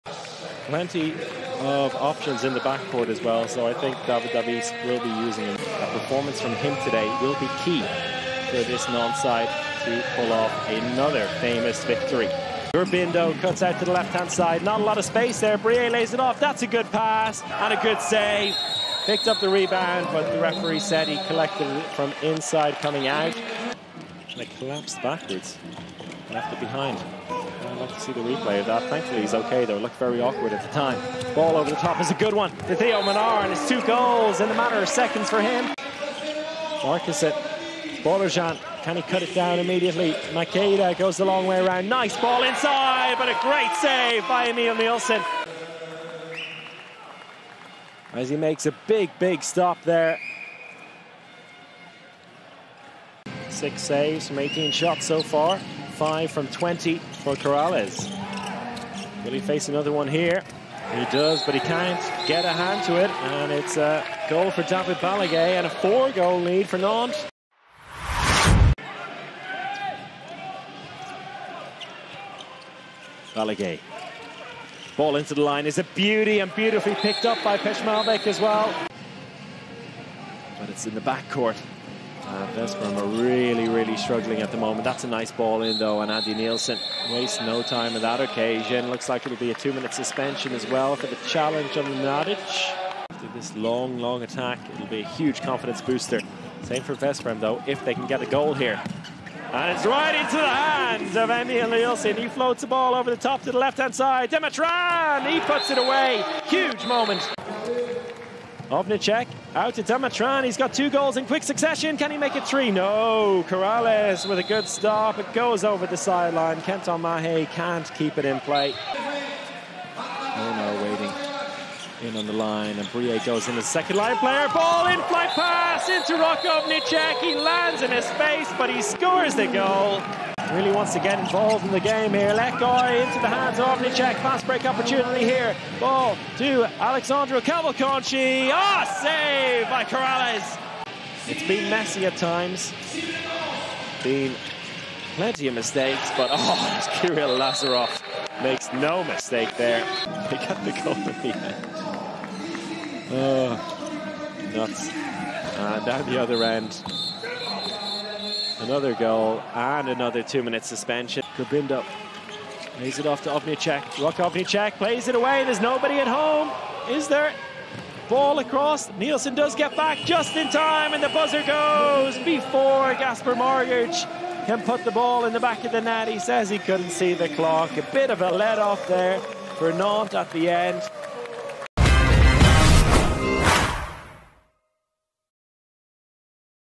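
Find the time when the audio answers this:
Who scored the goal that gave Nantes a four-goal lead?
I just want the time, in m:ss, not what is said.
1:04.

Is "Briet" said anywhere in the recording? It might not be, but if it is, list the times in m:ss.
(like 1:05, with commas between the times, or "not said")
0:15, 2:02.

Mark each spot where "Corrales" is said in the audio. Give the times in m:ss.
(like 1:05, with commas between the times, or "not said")
0:57, 1:53, 2:19.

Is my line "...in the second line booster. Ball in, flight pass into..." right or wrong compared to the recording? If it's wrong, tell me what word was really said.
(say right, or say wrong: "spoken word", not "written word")
wrong: "player", not "booster".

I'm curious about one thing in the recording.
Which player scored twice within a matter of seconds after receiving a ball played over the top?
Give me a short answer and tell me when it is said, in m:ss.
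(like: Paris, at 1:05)
Theo Menard, at 0:32.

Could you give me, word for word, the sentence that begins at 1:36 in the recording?
Same for Veszprem, though, if they can get a goal here.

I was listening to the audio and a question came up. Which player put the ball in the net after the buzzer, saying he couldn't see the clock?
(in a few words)
Gasper Marguc.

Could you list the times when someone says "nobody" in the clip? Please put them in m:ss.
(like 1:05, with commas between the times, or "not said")
2:45.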